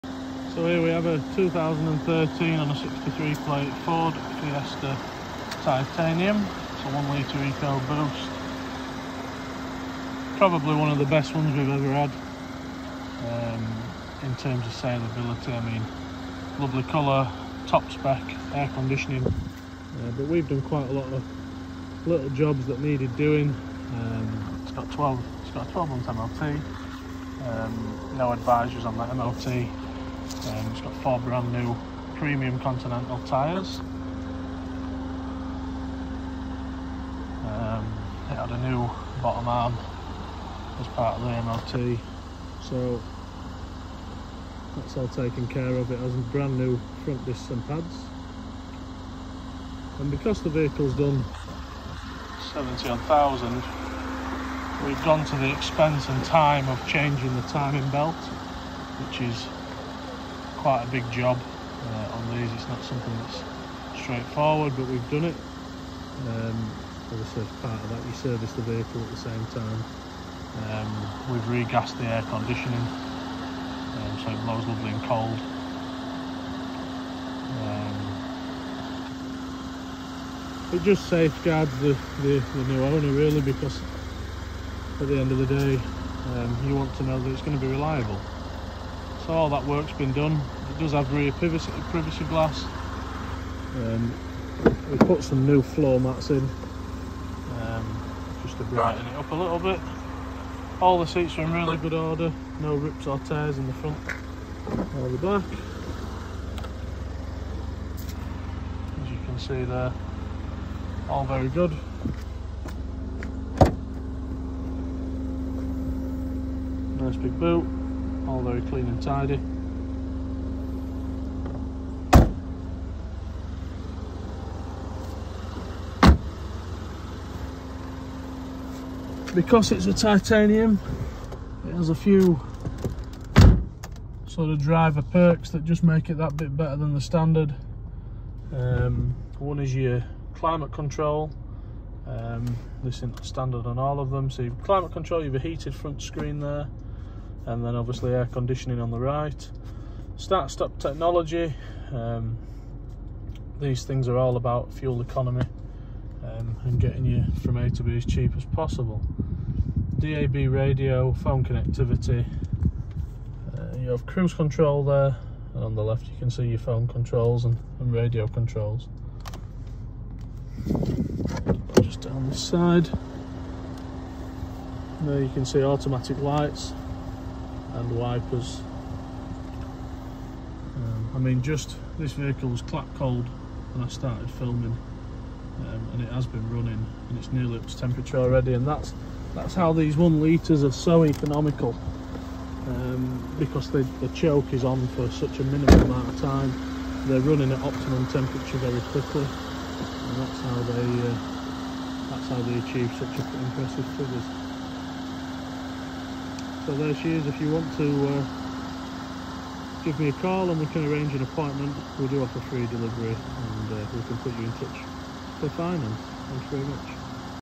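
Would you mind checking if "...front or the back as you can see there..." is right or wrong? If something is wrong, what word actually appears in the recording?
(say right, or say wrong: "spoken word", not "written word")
right.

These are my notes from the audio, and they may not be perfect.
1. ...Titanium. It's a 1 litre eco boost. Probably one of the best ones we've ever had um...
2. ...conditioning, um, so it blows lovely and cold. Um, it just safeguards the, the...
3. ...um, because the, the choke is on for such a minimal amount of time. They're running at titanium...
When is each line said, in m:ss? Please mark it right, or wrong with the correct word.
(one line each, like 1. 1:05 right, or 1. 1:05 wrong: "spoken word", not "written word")
1. 0:05 right
2. 1:12 right
3. 3:12 wrong: "optimum", not "titanium".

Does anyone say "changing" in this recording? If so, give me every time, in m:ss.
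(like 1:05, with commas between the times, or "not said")
0:56.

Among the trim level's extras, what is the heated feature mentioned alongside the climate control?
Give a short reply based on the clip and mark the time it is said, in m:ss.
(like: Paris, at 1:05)
Heated front screen, at 2:25.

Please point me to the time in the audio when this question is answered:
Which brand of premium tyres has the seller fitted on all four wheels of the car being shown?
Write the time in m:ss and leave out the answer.
0:32.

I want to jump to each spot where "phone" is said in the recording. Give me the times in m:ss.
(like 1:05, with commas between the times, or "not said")
2:41, 2:46.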